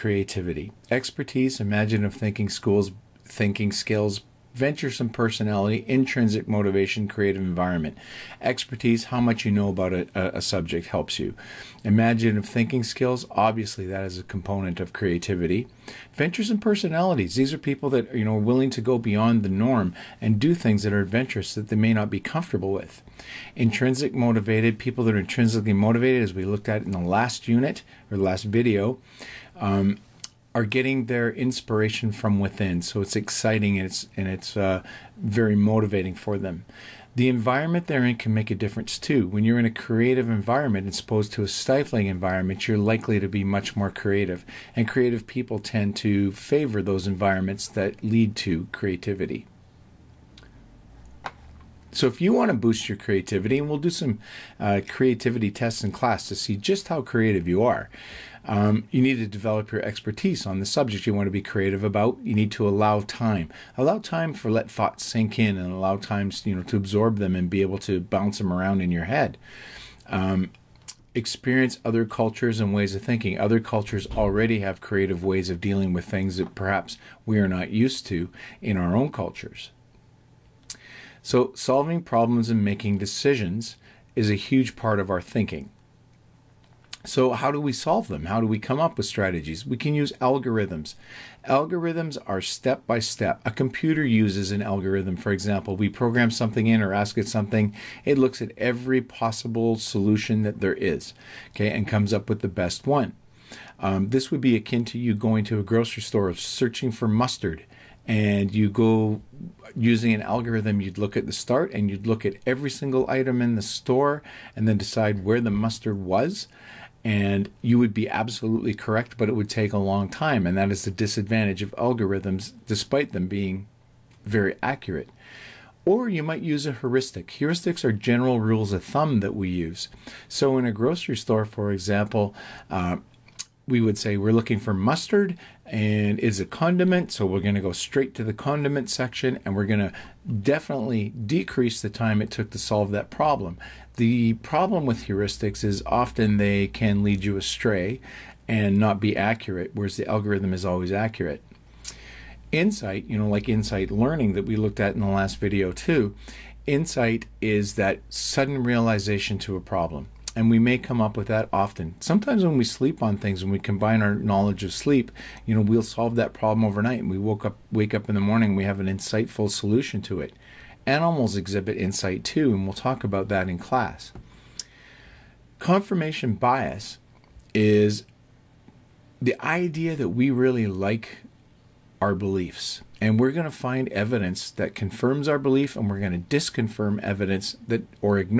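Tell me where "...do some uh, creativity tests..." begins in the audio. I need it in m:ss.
0:53.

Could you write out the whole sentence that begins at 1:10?
Um, experience other cultures and ways of thinking.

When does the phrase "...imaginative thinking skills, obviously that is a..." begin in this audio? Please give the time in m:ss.
0:11.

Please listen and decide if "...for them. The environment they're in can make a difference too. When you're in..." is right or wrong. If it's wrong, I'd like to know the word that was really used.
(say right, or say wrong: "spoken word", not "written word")
right.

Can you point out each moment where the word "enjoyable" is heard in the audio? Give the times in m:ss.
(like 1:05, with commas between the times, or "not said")
not said.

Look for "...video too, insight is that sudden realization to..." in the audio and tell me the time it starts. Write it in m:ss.
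2:35.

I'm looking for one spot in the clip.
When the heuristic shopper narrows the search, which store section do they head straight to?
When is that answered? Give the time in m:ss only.
2:18.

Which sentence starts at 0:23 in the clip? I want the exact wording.
Intrinsic motivated people that are intrinsically motivated, as we looked at in the last unit or last video.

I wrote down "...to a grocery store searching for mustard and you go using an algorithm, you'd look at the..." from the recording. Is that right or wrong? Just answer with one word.
right.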